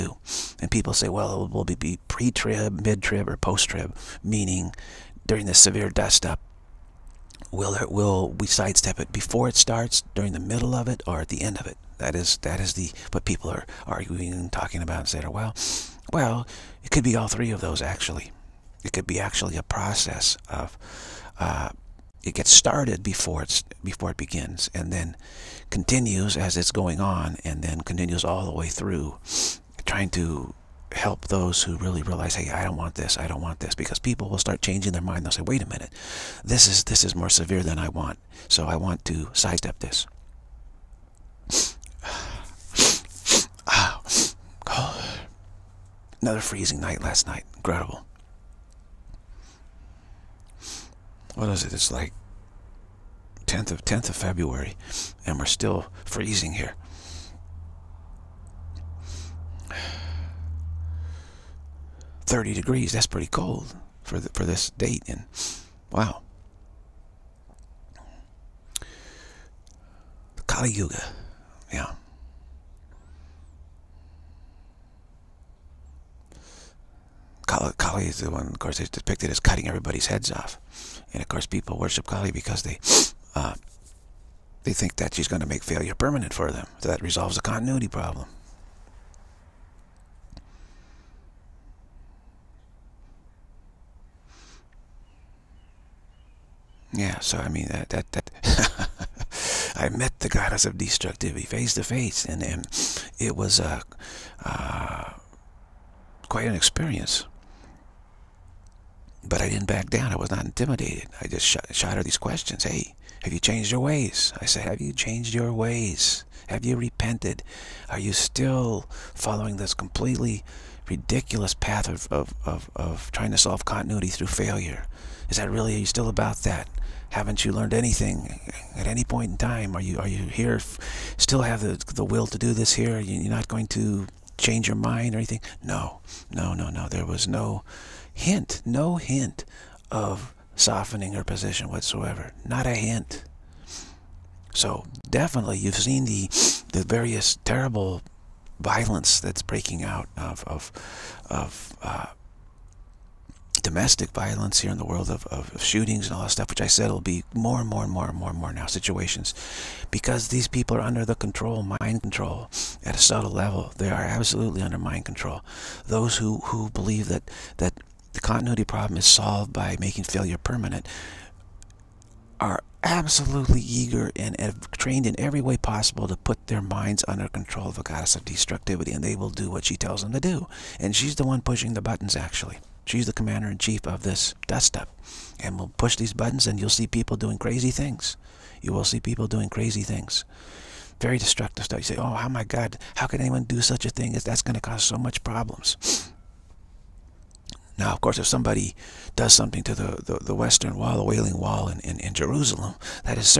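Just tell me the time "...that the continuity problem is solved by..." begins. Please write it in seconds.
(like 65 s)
167 s.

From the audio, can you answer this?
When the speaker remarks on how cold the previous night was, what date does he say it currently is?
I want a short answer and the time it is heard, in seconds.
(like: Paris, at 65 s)
10th of February, at 53 s.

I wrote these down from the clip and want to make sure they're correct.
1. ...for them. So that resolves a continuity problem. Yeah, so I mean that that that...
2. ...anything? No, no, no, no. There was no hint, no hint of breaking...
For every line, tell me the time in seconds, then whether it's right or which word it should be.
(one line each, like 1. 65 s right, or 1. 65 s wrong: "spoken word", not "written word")
1. 86 s right
2. 135 s wrong: "softening", not "breaking".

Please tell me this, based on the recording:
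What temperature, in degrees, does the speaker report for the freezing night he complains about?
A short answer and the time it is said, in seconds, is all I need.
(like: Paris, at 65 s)
30 degrees, at 62 s.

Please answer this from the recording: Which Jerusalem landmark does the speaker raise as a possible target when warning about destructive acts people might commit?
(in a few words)
Western Wall.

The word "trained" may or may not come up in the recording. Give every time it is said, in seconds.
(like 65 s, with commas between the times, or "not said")
174 s.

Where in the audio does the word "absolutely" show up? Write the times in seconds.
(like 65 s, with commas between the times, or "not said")
164 s, 172 s.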